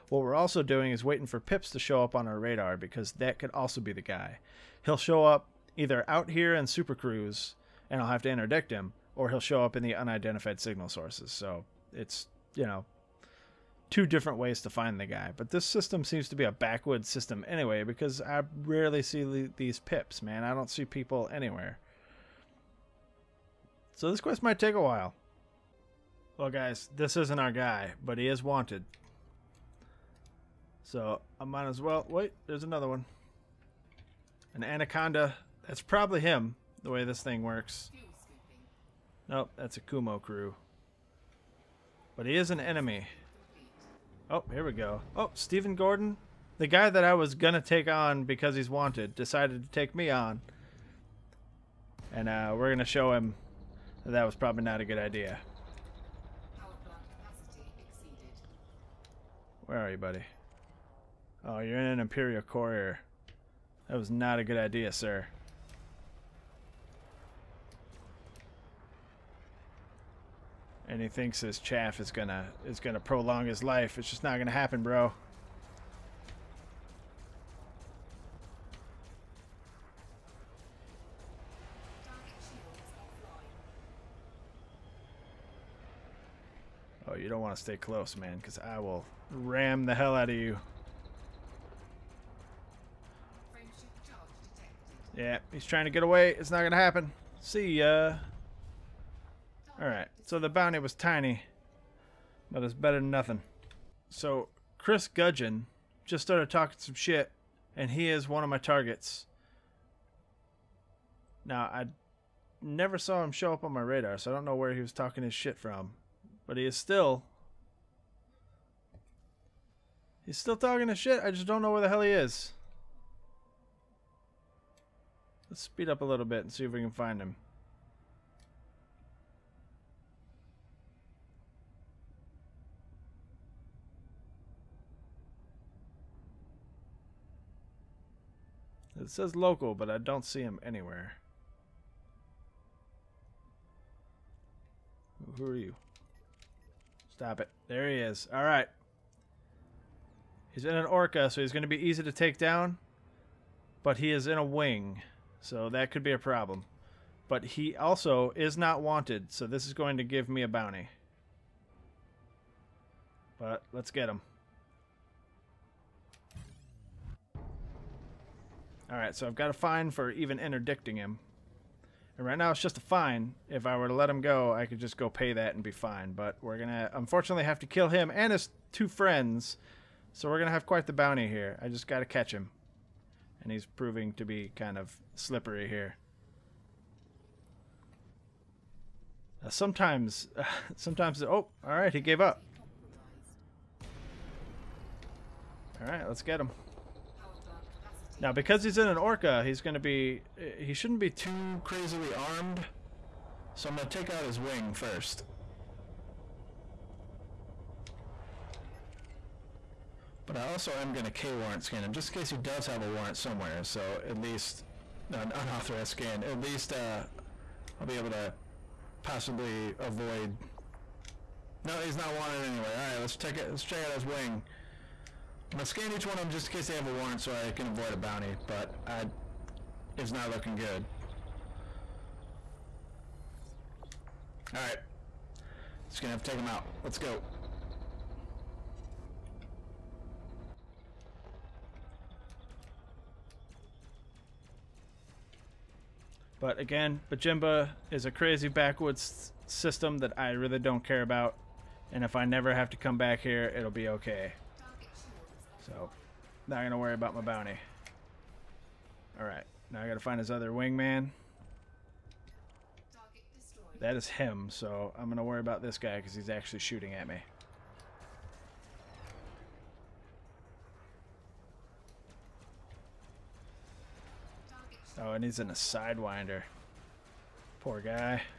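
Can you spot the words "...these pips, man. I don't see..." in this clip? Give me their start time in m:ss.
0:19.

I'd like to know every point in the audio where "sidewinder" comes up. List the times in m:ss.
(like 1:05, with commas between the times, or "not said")
4:35.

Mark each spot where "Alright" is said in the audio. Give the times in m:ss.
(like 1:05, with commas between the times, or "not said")
1:39, 2:48, 3:54, 4:19.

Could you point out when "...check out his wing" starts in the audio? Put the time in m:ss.
3:43.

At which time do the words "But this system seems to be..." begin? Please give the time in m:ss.
0:15.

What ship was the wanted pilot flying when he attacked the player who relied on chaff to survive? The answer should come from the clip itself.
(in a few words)
Imperial Courier.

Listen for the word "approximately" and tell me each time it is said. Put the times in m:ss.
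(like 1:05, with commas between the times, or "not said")
not said.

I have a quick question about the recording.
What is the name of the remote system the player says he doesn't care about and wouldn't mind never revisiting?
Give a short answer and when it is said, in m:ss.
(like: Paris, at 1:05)
Bajimba, at 4:07.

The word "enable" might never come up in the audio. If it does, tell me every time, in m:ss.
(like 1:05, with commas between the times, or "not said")
not said.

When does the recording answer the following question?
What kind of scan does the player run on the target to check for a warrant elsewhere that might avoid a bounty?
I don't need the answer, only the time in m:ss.
3:31.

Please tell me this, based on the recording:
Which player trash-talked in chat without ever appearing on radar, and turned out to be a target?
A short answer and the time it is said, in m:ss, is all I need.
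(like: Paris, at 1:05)
Chris Gudgeon, at 1:44.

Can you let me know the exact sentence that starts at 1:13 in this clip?
It's just not gonna happen, bro.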